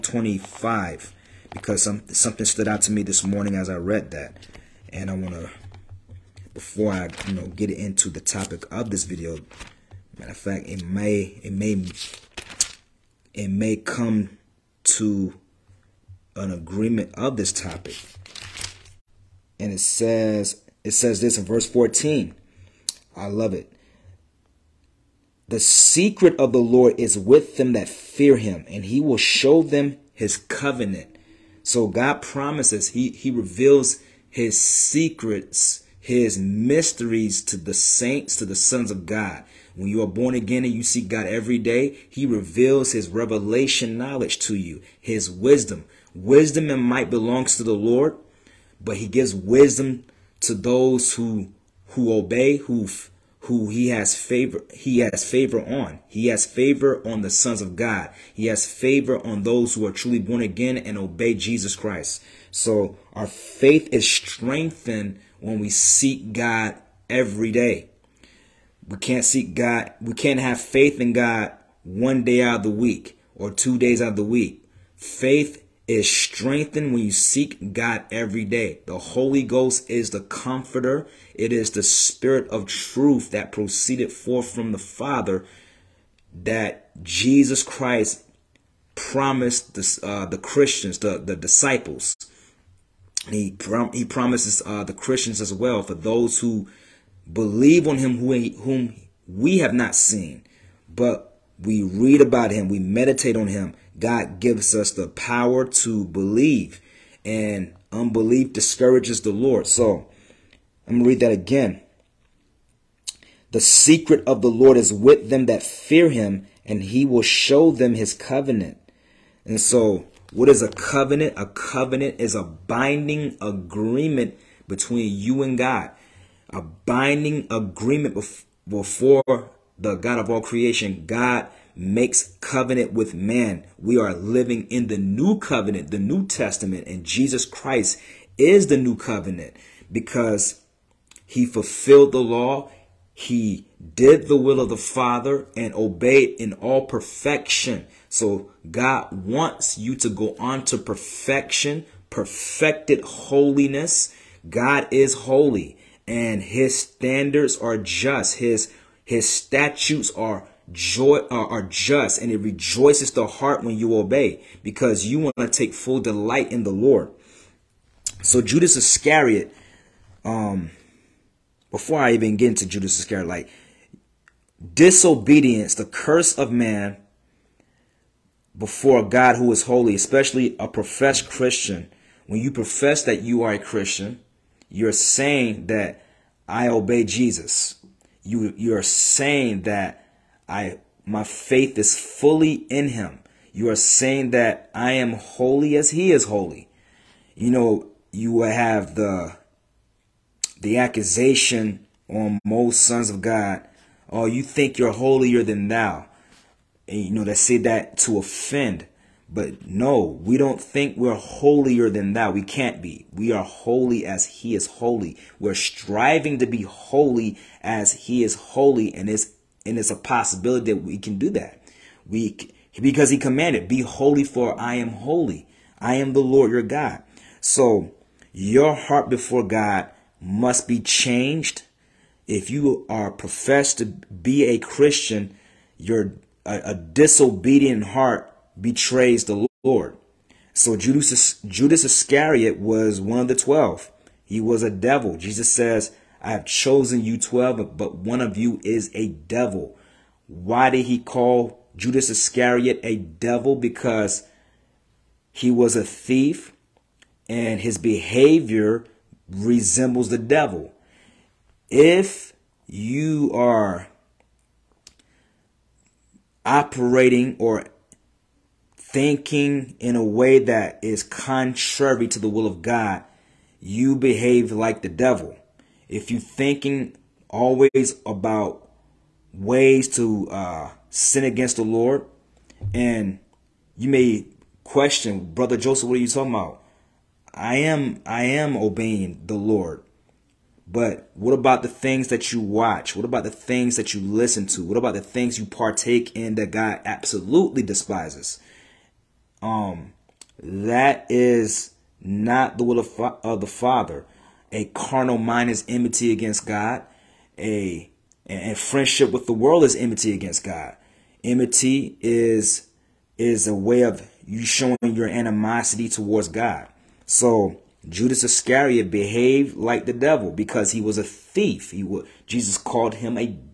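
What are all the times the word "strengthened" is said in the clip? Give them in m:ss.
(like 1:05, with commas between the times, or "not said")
1:04, 1:16.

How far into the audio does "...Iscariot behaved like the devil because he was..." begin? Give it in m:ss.
5:18.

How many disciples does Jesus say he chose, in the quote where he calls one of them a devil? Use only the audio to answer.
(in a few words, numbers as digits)
12.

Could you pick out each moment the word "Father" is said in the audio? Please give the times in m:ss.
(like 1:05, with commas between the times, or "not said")
1:24, 2:24, 5:03.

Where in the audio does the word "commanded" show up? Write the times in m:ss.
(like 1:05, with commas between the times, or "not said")
3:43.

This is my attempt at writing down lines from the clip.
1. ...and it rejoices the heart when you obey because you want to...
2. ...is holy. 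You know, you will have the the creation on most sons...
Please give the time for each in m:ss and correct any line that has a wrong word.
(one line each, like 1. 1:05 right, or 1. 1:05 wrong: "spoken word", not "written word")
1. 2:42 right
2. 3:16 wrong: "accusation", not "creation".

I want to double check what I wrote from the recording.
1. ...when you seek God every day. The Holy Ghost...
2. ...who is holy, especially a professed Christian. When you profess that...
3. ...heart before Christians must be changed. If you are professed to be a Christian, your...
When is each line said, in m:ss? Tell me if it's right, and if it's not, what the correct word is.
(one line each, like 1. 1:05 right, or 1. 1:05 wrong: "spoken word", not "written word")
1. 1:16 right
2. 2:59 right
3. 3:48 wrong: "God", not "Christians".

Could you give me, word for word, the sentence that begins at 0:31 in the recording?
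So God promises, he, he reveals his secrets, his mysteries to the saints, to the sons of God.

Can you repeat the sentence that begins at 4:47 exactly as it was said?
I am I am obeying the Lord.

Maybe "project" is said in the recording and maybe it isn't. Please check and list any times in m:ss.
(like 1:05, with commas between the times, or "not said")
not said.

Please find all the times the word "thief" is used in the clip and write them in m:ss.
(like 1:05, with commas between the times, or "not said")
4:15, 5:21.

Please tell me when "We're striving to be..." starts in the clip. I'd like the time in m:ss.
3:35.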